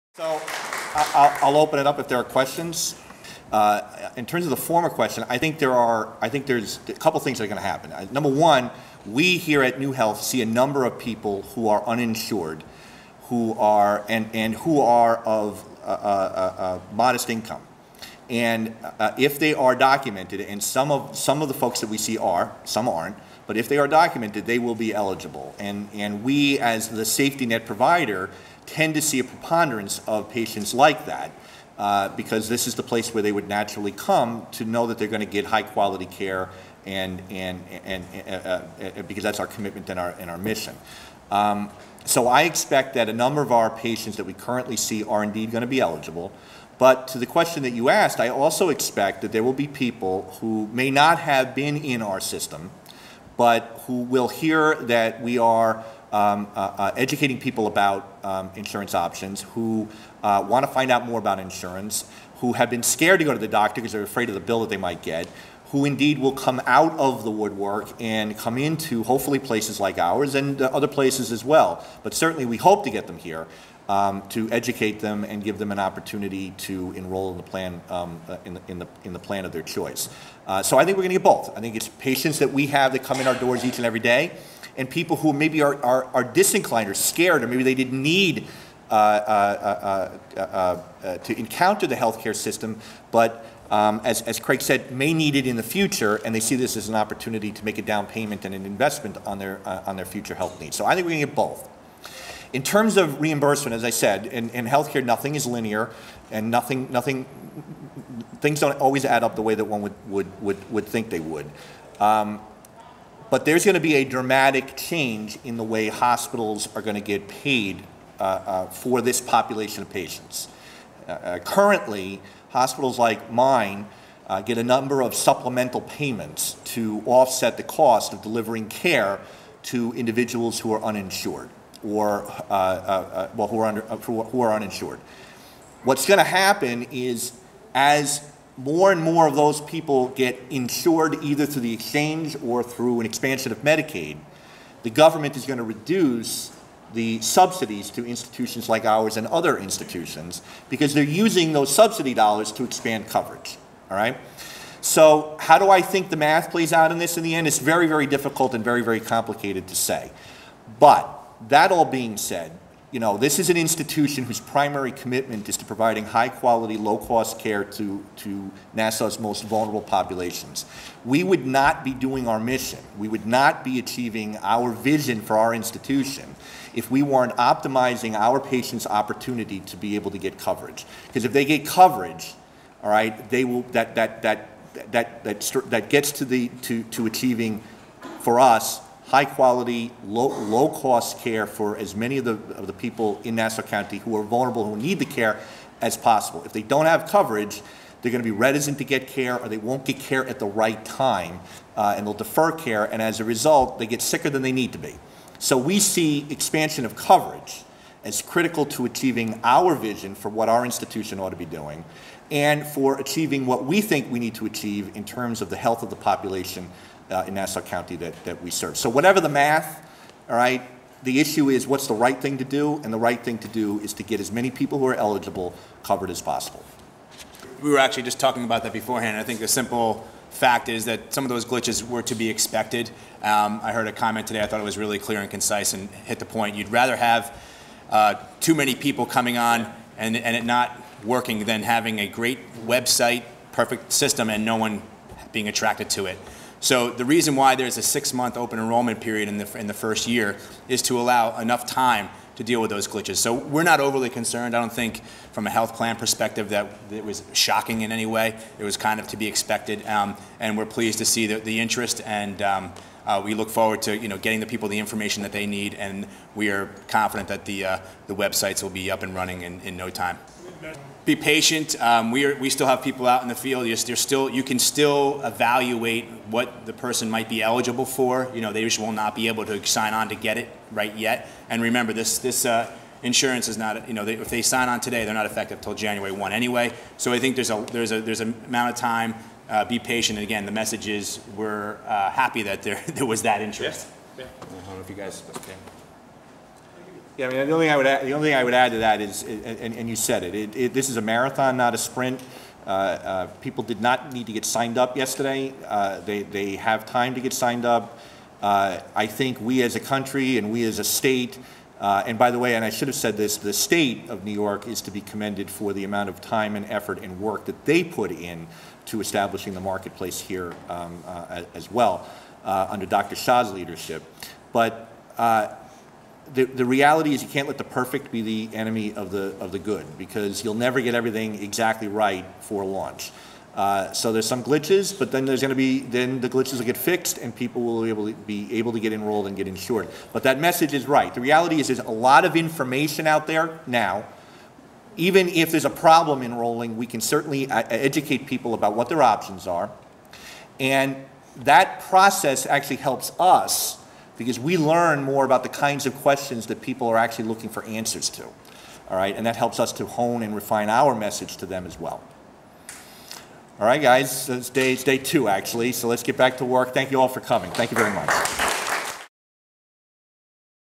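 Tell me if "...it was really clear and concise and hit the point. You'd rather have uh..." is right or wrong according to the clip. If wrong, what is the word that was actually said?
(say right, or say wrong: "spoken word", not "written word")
right.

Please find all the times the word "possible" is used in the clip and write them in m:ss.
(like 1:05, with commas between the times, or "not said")
3:15, 3:46.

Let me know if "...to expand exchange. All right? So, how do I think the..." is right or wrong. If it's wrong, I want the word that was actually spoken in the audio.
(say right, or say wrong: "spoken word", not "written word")
wrong: "coverage", not "exchange".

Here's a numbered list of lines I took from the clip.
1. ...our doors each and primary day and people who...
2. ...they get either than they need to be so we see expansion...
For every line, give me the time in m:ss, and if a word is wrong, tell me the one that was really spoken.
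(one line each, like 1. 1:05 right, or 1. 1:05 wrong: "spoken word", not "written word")
1. 1:23 wrong: "every", not "primary"
2. 3:23 wrong: "sicker", not "either".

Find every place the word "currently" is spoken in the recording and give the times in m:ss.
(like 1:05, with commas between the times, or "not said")
0:44, 2:01.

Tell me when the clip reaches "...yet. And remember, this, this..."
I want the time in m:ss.
4:40.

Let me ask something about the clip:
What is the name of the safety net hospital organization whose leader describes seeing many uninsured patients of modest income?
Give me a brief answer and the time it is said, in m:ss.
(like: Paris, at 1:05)
NuHealth, at 0:09.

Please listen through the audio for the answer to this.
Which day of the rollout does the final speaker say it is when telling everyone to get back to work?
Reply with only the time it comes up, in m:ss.
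6:04.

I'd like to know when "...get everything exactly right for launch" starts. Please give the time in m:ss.
5:30.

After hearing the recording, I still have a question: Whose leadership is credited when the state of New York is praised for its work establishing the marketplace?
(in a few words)
Dr. Shah.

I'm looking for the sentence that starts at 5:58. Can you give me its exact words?
All right, and that helps us to hone and refine our message to them as well.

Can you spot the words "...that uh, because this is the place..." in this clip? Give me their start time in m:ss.
0:31.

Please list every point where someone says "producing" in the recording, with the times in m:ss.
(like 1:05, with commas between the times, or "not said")
not said.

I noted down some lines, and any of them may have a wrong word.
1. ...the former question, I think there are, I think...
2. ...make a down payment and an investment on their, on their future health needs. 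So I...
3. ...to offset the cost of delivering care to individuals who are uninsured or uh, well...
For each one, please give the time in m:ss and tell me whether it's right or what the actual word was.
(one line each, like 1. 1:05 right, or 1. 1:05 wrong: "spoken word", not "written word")
1. 0:04 right
2. 1:37 right
3. 2:06 right.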